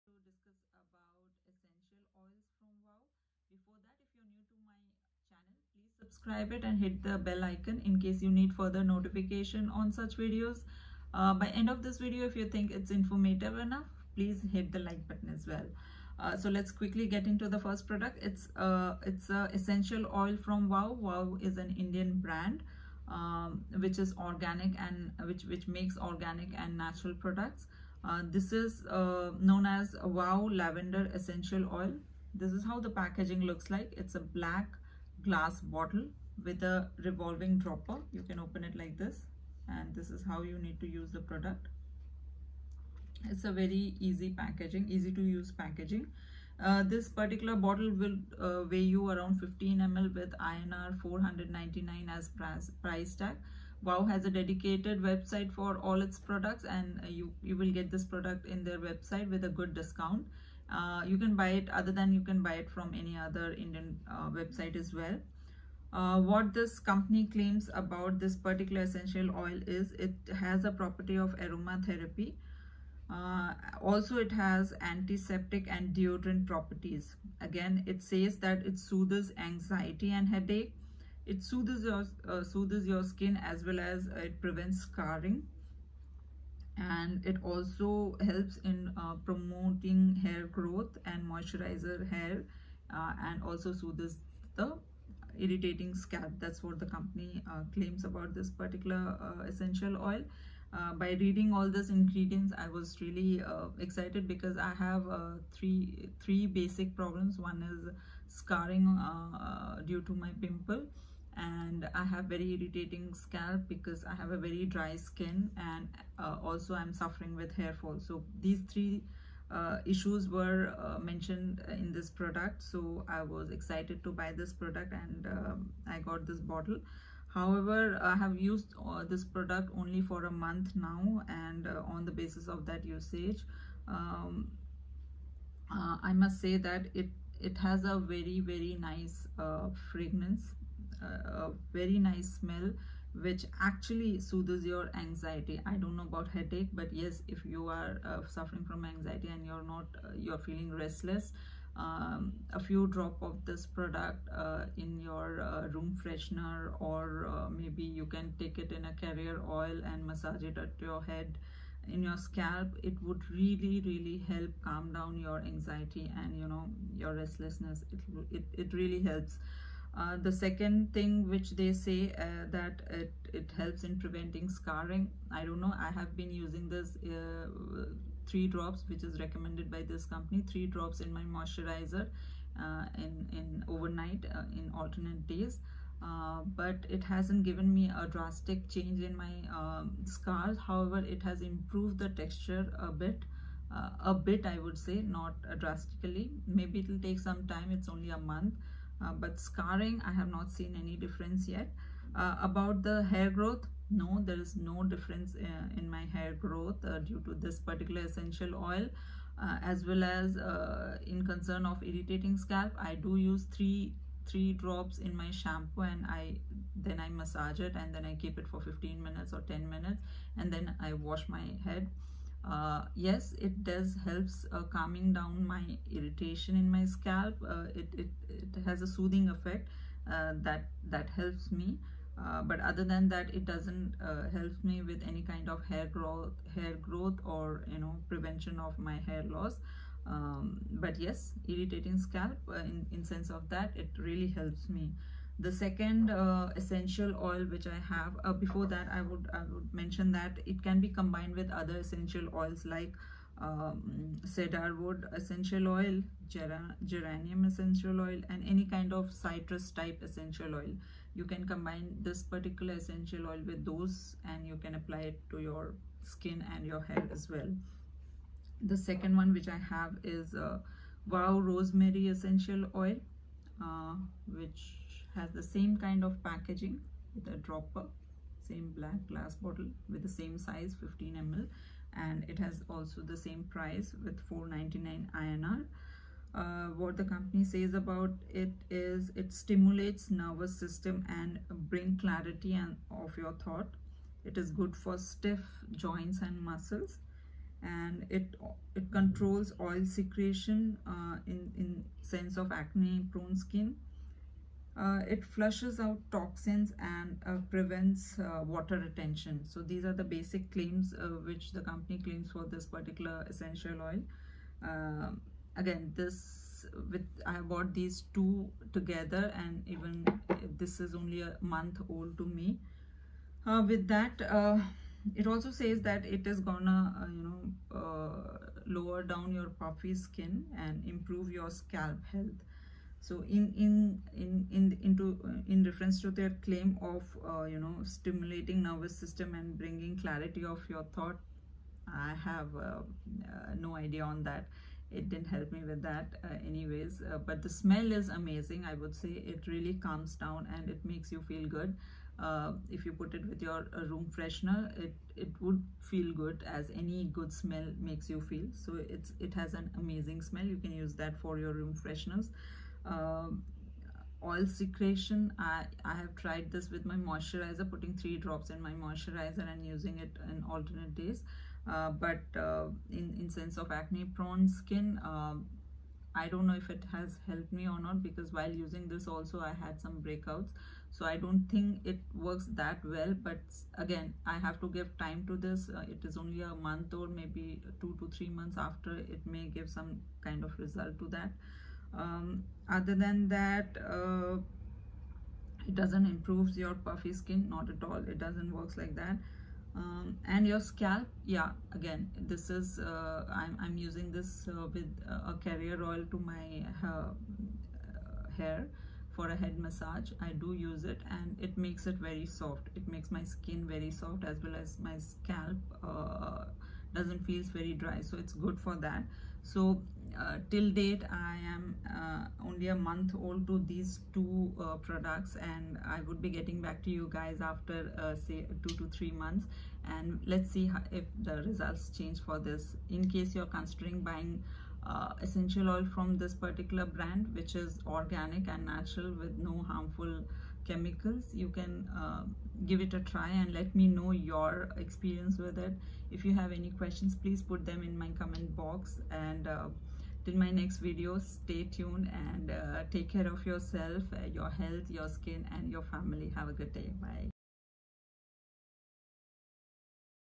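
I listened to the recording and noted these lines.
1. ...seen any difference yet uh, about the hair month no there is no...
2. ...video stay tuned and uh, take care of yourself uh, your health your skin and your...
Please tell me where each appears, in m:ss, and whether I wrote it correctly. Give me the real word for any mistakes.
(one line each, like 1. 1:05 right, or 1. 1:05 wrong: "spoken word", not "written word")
1. 3:20 wrong: "growth", not "month"
2. 7:30 right.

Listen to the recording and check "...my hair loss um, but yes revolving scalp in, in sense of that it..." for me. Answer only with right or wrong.
wrong.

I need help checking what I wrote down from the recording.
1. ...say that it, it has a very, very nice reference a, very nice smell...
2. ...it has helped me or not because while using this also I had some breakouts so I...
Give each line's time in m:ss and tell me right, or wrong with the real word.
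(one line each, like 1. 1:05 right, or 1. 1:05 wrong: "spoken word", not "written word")
1. 2:16 wrong: "fragrance", not "reference"
2. 6:16 right.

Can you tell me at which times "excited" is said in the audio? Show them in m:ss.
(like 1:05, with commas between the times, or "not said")
1:43, 2:03.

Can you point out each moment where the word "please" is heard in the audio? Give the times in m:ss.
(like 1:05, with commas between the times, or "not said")
0:05, 0:14, 7:27.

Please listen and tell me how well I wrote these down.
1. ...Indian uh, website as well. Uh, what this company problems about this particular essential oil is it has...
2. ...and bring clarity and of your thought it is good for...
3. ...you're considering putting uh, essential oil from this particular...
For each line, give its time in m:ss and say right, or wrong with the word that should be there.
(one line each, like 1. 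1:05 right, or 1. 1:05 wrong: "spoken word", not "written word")
1. 1:03 wrong: "claims", not "problems"
2. 4:51 right
3. 7:13 wrong: "buying", not "putting".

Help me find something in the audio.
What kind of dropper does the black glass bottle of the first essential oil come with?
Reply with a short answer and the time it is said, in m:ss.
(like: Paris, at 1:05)
Revolving dropper, at 0:37.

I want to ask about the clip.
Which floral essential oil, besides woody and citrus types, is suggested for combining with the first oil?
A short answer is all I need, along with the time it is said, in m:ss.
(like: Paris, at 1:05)
Geranium, at 4:16.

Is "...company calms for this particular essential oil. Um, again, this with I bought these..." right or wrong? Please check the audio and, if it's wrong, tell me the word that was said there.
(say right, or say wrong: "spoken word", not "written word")
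wrong: "claims", not "calms".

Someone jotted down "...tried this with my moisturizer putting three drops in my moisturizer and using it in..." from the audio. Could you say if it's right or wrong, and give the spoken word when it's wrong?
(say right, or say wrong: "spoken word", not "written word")
right.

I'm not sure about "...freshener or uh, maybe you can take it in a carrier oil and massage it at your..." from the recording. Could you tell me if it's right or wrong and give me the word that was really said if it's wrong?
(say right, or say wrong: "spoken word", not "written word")
right.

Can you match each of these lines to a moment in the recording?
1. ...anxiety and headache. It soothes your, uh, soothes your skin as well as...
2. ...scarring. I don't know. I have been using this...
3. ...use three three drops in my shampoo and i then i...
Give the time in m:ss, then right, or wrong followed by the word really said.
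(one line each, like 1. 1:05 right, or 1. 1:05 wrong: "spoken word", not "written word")
1. 1:19 right
2. 2:54 right
3. 3:33 right.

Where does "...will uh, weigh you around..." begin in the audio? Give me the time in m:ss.
0:47.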